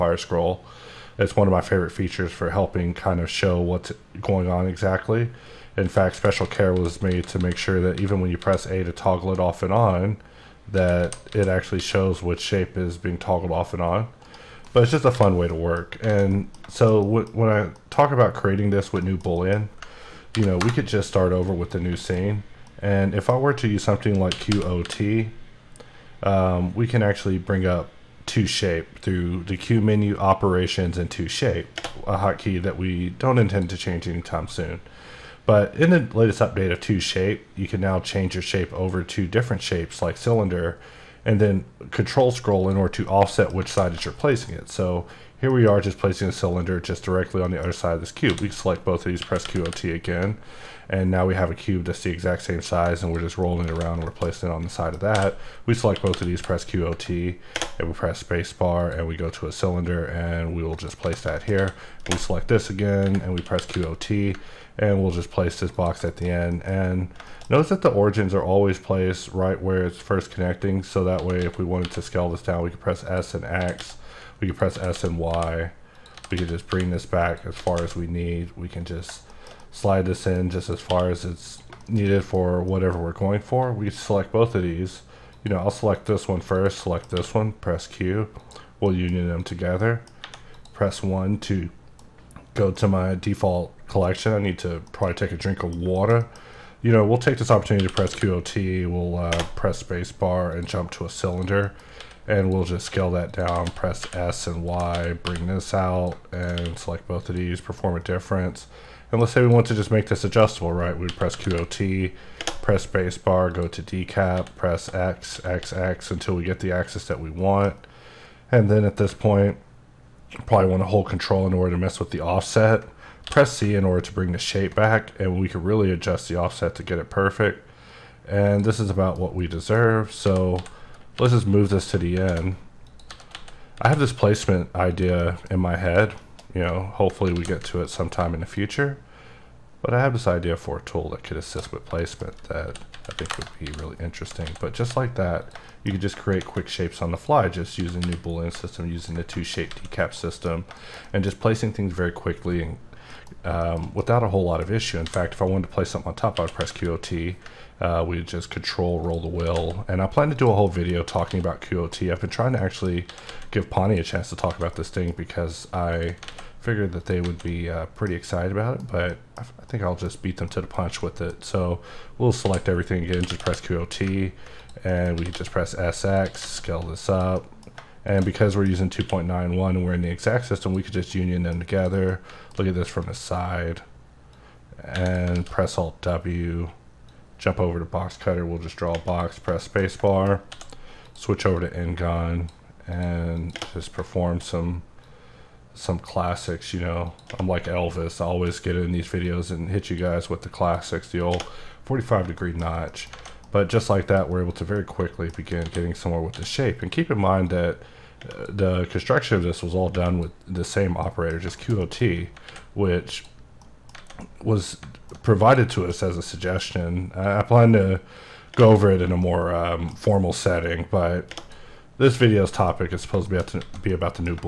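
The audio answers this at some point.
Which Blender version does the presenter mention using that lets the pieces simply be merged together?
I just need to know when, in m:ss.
2:58.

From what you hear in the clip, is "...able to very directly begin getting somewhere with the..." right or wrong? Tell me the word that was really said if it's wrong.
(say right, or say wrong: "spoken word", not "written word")
wrong: "quickly", not "directly".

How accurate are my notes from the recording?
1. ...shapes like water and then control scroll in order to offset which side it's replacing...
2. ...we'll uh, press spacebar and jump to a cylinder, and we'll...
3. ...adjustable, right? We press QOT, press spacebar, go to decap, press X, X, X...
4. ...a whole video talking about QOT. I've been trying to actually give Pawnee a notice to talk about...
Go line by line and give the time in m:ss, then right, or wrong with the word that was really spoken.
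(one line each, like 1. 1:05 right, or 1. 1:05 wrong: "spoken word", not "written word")
1. 0:39 wrong: "cylinder", not "water"
2. 1:38 right
3. 1:50 right
4. 2:40 wrong: "chance", not "notice".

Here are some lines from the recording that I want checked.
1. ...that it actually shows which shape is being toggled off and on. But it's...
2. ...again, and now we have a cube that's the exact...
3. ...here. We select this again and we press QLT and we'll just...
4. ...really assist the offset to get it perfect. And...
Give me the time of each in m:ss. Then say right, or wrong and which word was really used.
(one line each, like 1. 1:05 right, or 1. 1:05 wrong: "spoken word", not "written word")
1. 0:10 right
2. 0:49 right
3. 1:01 right
4. 2:05 wrong: "adjust", not "assist".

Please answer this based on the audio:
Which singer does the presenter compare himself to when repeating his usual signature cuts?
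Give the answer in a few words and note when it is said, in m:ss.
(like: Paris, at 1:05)
Elvis, at 3:17.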